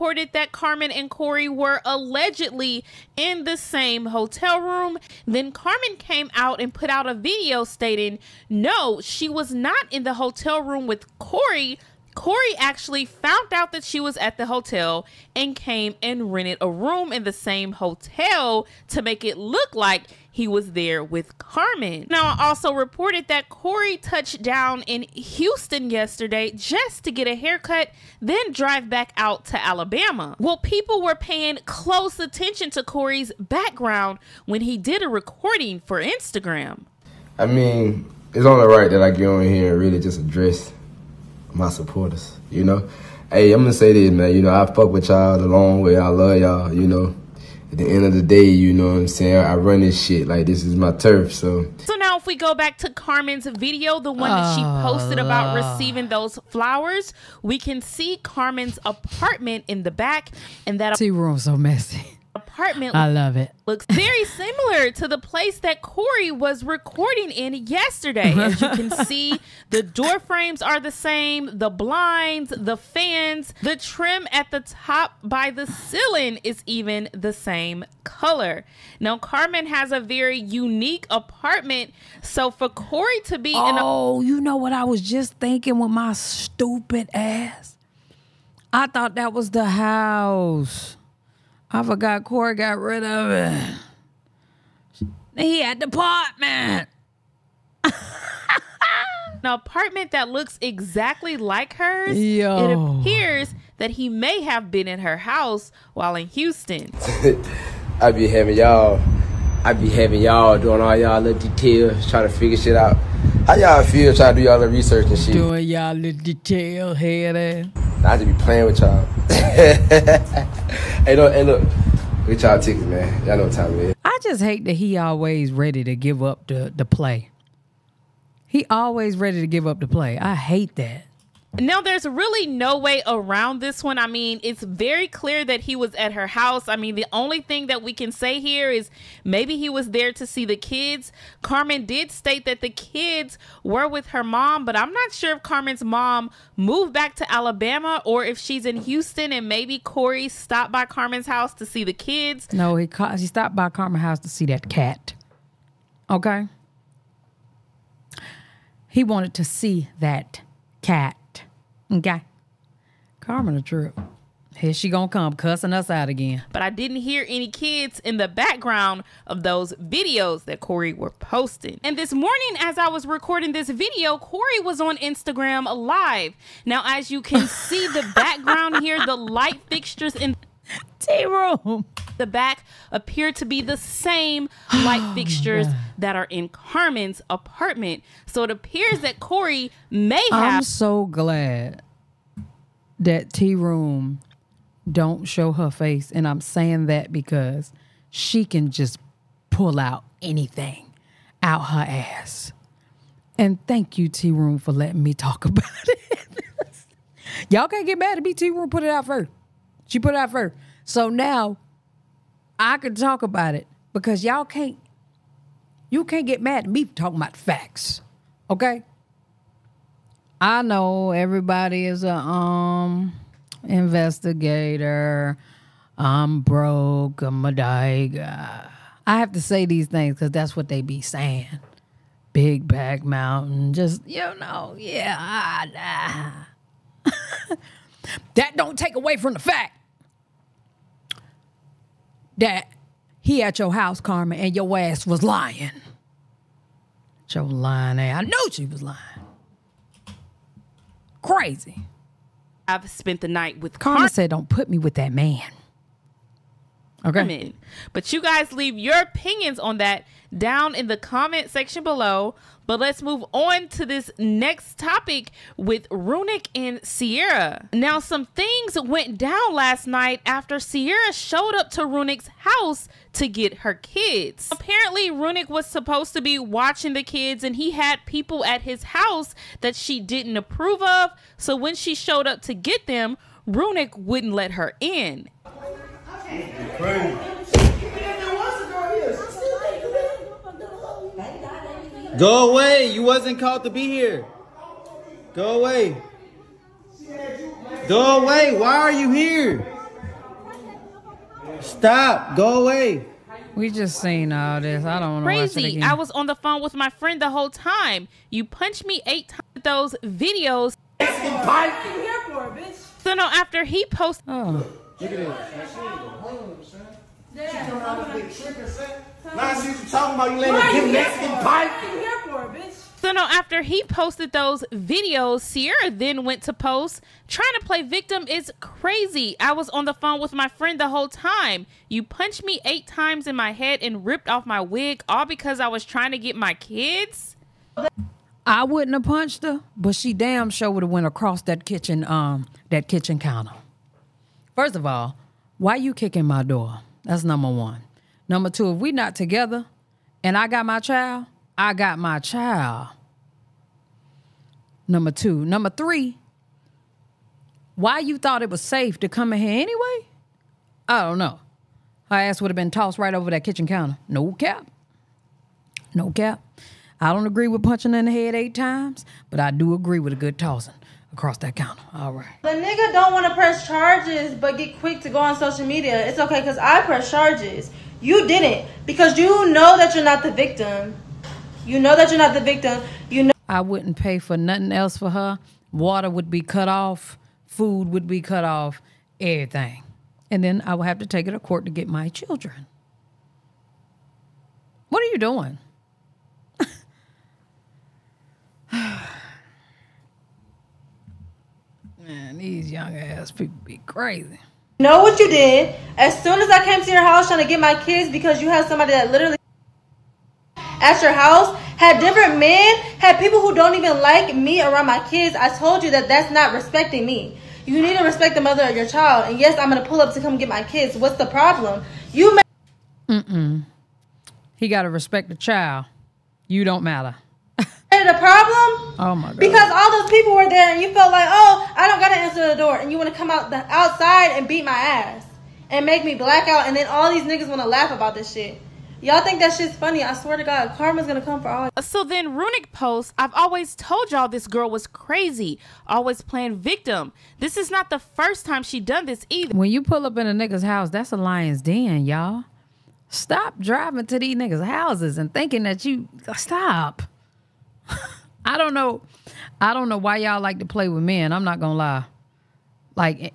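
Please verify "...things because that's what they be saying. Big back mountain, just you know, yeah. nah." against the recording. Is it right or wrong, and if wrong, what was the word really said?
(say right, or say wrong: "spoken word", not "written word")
right.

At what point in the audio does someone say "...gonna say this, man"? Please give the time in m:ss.
0:43.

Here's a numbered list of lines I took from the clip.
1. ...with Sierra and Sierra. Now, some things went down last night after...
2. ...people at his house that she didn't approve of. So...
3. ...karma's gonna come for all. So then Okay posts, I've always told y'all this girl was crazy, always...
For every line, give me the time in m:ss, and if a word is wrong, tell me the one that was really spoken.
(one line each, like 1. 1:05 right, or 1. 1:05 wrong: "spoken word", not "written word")
1. 4:25 wrong: "Runik", not "Sierra"
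2. 4:38 right
3. 7:20 wrong: "Runik", not "Okay".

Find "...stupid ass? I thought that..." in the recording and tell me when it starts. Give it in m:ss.
1:26.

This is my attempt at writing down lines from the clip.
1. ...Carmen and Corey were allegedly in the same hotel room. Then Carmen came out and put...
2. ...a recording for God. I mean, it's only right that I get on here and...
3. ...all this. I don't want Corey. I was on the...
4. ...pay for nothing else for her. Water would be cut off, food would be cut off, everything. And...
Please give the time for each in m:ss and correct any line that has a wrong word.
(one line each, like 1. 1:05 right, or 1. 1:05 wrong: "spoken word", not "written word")
1. 0:00 right
2. 0:35 wrong: "Instagram", not "God"
3. 5:04 wrong: "Crazy", not "Corey"
4. 6:23 right.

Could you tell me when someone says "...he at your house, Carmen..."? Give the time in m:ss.
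4:03.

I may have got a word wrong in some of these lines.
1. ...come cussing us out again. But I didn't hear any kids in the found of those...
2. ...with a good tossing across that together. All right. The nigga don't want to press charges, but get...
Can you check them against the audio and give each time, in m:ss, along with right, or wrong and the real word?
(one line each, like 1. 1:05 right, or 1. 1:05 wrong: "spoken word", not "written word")
1. 2:45 wrong: "background", not "found"
2. 6:09 wrong: "counter", not "together".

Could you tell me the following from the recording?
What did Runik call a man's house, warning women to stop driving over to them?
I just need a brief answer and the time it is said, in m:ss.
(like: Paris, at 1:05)
a lion's den, at 7:31.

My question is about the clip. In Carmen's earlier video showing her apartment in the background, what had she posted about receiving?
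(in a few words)
flowers.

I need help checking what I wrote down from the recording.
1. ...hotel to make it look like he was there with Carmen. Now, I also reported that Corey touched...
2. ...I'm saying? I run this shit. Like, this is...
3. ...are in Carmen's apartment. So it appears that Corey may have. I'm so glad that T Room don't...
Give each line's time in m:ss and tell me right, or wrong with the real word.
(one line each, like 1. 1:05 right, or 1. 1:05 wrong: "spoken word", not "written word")
1. 0:17 right
2. 0:48 right
3. 3:06 right.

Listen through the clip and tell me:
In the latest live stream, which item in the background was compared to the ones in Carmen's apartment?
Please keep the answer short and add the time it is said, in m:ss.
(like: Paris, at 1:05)
light fixtures, at 2:59.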